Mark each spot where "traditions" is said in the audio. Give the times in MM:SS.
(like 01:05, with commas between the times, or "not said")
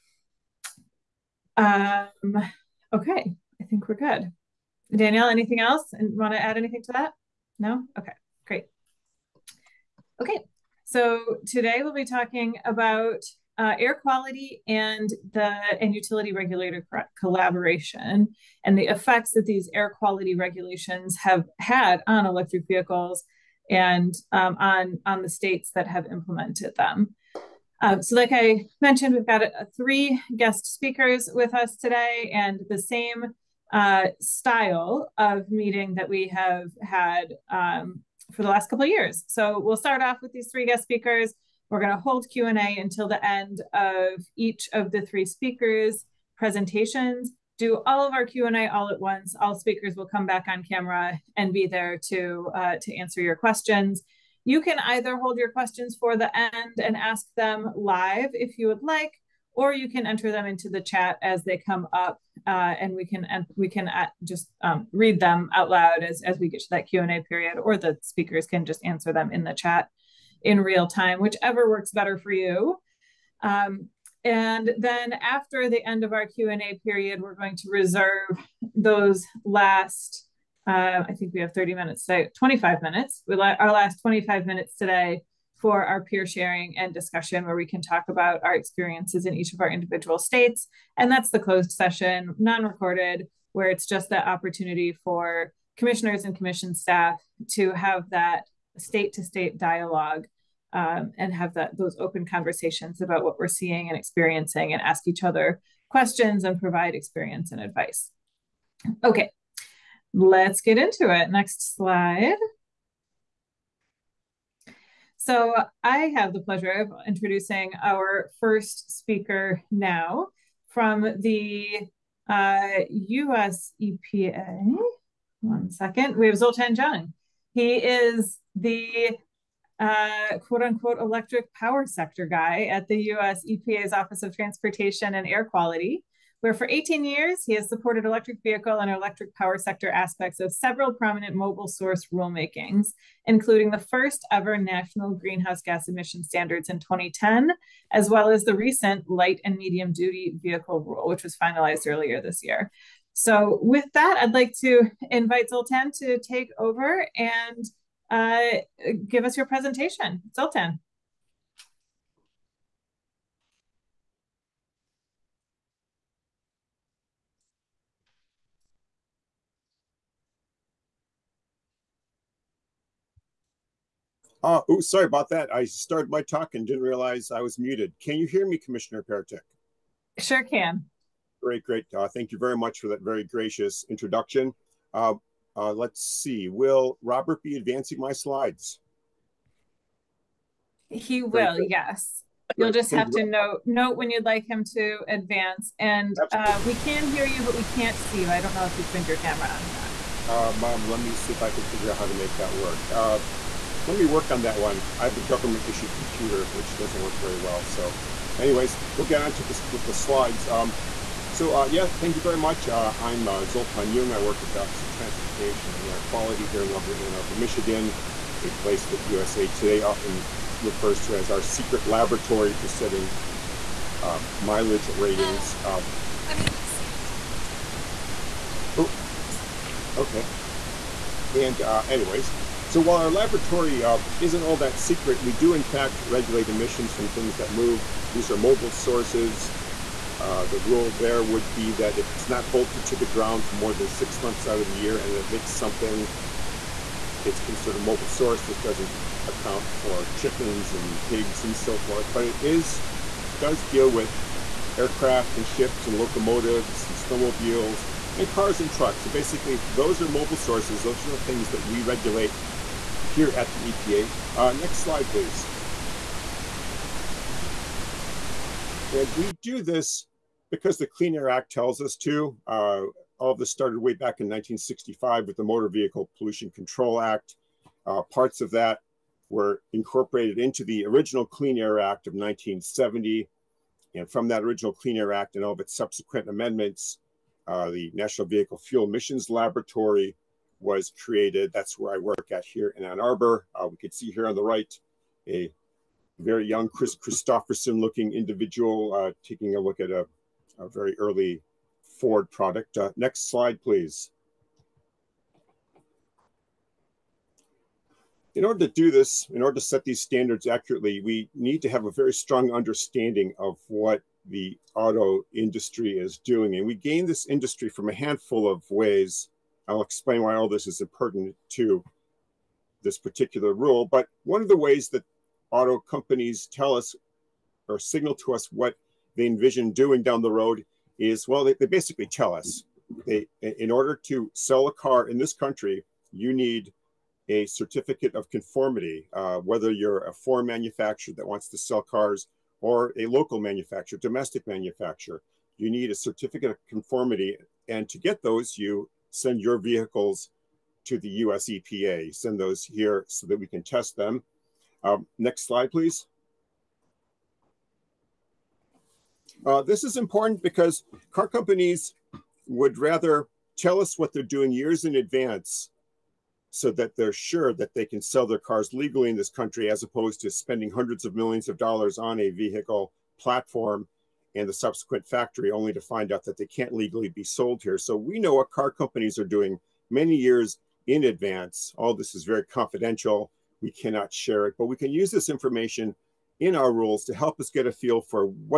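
not said.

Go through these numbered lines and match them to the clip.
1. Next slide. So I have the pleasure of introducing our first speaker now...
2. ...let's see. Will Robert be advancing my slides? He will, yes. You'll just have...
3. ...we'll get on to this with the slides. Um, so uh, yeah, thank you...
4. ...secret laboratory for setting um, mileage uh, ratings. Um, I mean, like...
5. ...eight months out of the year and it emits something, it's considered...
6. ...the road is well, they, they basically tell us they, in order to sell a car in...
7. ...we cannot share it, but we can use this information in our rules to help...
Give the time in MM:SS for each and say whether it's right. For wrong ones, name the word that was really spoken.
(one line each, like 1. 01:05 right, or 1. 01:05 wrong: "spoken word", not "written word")
1. 01:51 right
2. 03:05 right
3. 03:28 right
4. 03:41 right
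5. 04:03 wrong: "six", not "eight"
6. 05:30 right
7. 06:23 right.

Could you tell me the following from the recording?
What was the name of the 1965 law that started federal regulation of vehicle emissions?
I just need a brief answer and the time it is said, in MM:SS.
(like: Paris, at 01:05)
Motor Vehicle Pollution Control Act, at 04:35.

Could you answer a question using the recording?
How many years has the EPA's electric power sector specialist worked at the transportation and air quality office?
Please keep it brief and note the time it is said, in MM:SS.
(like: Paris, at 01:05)
18, at 02:16.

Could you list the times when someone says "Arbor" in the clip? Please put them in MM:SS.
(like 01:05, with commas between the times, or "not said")
03:37, 04:52.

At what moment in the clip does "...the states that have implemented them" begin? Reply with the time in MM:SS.
00:25.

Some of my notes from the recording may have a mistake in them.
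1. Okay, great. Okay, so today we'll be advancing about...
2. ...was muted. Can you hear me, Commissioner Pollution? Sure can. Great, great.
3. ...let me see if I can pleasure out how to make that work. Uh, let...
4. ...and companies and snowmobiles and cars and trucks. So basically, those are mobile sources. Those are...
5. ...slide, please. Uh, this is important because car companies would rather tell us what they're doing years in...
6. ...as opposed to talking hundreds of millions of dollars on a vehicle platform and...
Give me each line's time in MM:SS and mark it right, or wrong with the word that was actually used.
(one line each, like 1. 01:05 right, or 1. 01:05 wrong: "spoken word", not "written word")
1. 00:07 wrong: "talking", not "advancing"
2. 02:57 wrong: "Peretick", not "Pollution"
3. 03:20 wrong: "figure", not "pleasure"
4. 04:15 wrong: "locomotives", not "companies"
5. 05:55 right
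6. 06:09 wrong: "spending", not "talking".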